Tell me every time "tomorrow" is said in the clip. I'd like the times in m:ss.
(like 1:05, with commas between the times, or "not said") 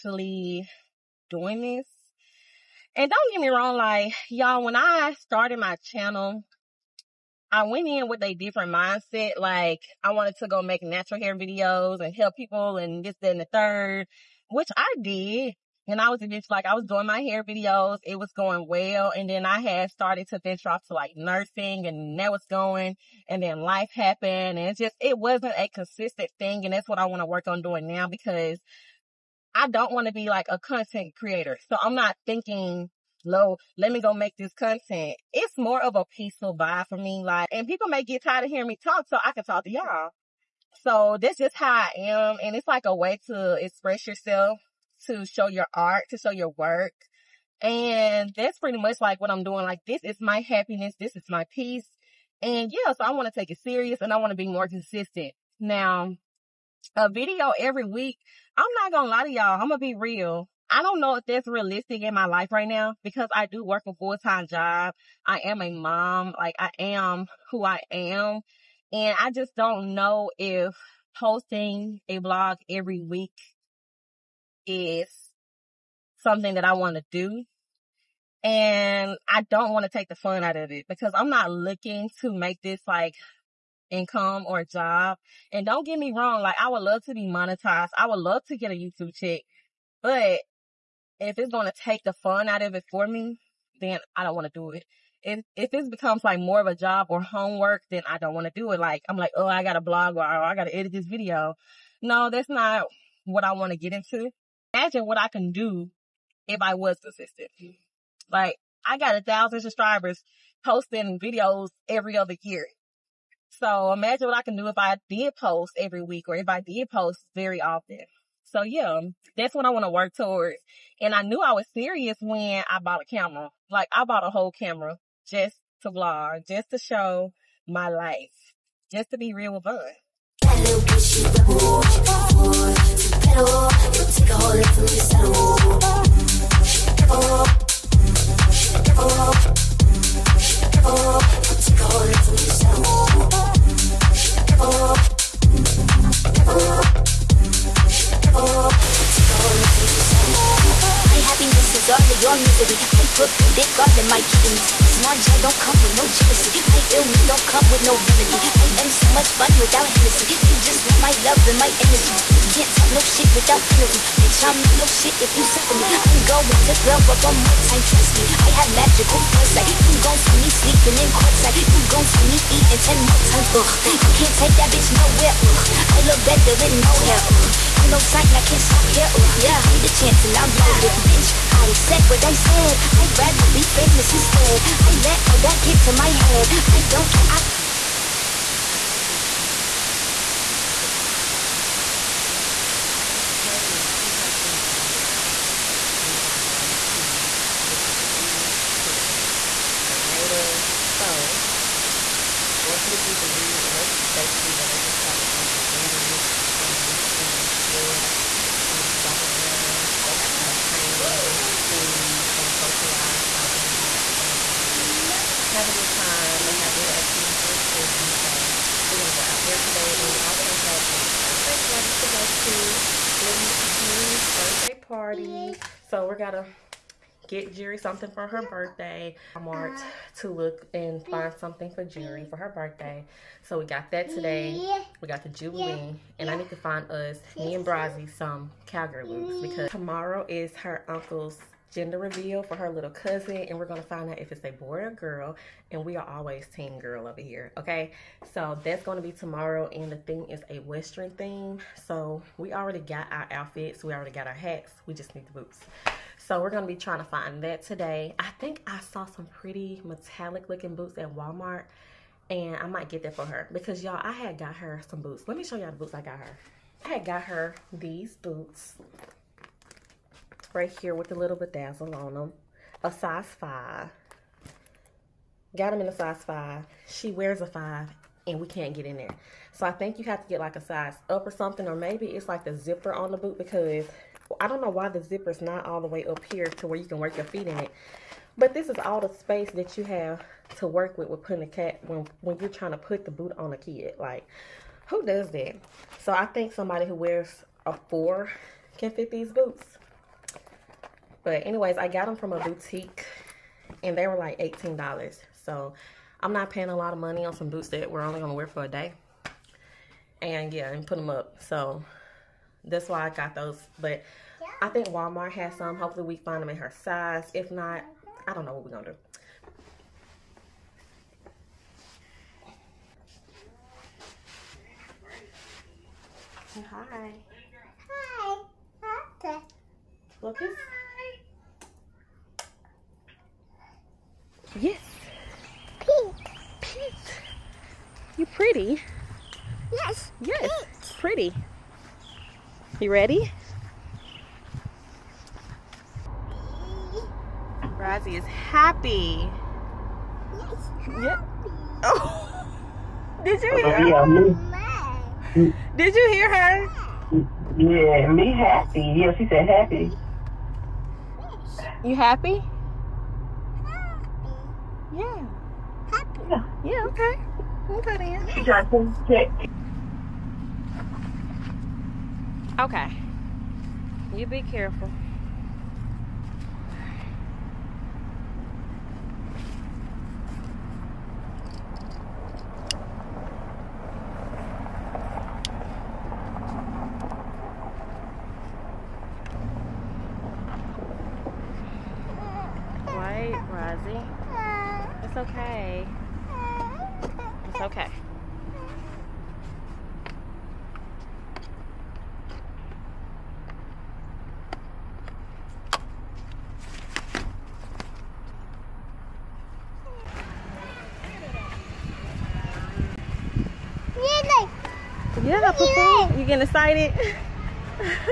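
3:59, 4:09.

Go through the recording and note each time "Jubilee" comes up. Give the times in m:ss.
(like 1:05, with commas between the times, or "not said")
3:17, 3:22, 3:55.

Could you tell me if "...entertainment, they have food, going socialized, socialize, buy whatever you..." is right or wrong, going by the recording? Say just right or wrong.
right.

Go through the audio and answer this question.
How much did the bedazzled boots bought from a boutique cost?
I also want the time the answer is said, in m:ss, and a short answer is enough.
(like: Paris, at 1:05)
$18, at 5:04.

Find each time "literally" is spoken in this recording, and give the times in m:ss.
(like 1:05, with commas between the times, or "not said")
not said.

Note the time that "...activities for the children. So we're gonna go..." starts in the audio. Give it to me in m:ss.
3:36.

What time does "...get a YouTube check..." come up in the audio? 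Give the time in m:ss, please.
1:28.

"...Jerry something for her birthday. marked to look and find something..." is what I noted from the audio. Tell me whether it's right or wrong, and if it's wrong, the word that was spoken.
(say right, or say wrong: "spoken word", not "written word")
right.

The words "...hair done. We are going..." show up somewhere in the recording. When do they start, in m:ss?
3:14.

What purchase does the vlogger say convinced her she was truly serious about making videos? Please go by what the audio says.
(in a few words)
A camera.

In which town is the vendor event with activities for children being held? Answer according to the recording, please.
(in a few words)
Grenada.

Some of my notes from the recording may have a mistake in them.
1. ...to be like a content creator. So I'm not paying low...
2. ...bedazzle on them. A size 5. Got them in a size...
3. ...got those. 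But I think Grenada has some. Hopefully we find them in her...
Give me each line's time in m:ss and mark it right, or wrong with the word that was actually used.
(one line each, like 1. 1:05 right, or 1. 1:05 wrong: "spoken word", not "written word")
1. 0:30 wrong: "thinking", not "paying"
2. 4:31 right
3. 5:13 wrong: "Walmart", not "Grenada".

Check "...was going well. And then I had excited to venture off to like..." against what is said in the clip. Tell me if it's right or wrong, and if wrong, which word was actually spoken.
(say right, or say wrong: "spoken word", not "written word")
wrong: "started", not "excited".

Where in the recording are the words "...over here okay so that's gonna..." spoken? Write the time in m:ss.
4:07.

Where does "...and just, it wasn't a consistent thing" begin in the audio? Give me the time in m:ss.
0:24.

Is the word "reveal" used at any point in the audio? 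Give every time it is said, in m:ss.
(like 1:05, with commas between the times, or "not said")
4:01.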